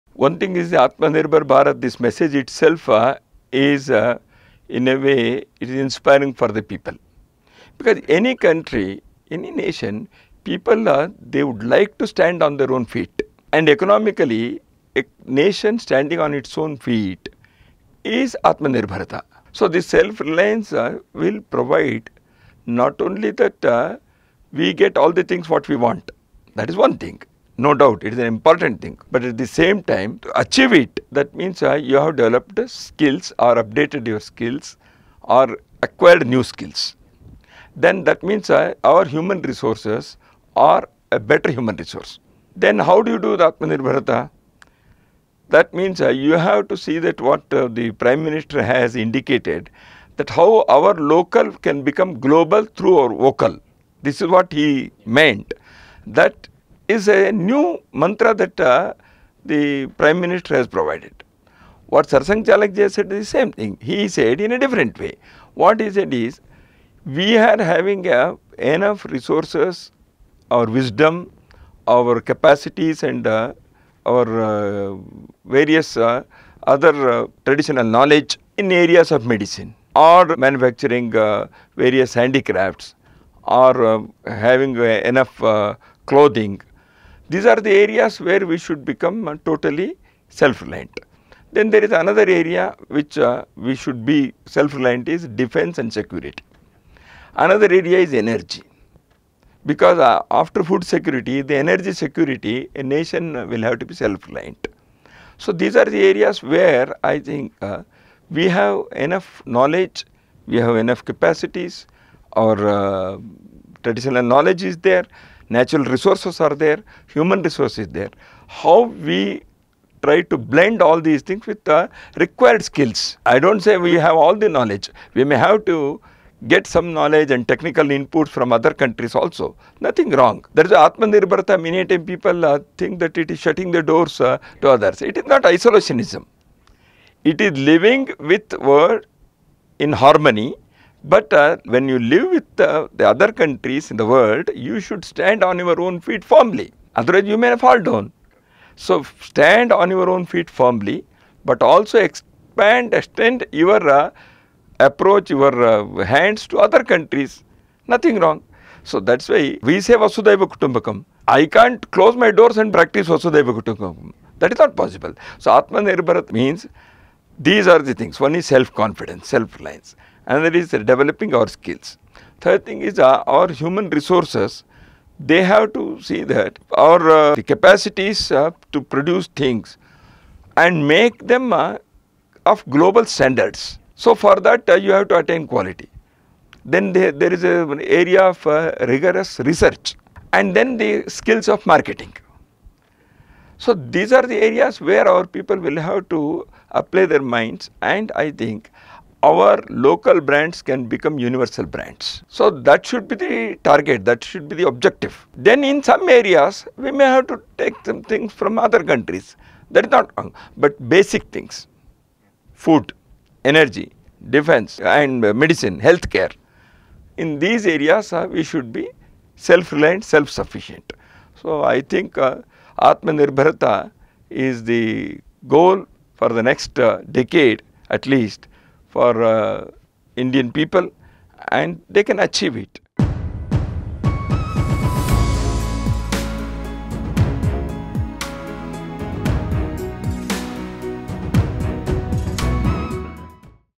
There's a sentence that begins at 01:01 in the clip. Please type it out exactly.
What Sarsang Chalakji said is the same thing.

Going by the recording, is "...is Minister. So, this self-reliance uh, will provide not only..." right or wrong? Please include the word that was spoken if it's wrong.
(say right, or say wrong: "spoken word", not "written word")
wrong: "Atmanirbharata", not "Minister".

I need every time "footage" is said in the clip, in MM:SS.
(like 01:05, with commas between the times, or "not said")
not said.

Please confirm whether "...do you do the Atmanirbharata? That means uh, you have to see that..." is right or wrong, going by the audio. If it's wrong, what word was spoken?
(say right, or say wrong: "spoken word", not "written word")
right.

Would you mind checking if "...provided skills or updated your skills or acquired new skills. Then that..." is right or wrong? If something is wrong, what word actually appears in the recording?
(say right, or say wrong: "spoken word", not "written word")
wrong: "developed", not "provided".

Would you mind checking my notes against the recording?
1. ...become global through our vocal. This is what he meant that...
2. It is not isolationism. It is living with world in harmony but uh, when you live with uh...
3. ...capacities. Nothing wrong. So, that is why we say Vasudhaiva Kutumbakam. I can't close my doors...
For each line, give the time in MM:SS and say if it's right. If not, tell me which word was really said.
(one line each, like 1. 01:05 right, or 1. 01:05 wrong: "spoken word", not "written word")
1. 00:51 right
2. 02:15 right
3. 02:36 wrong: "countries", not "capacities".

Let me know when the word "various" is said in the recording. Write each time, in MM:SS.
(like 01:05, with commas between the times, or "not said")
01:15, 01:21.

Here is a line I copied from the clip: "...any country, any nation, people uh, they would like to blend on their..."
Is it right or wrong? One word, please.
wrong.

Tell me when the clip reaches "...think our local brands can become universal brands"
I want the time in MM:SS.
03:18.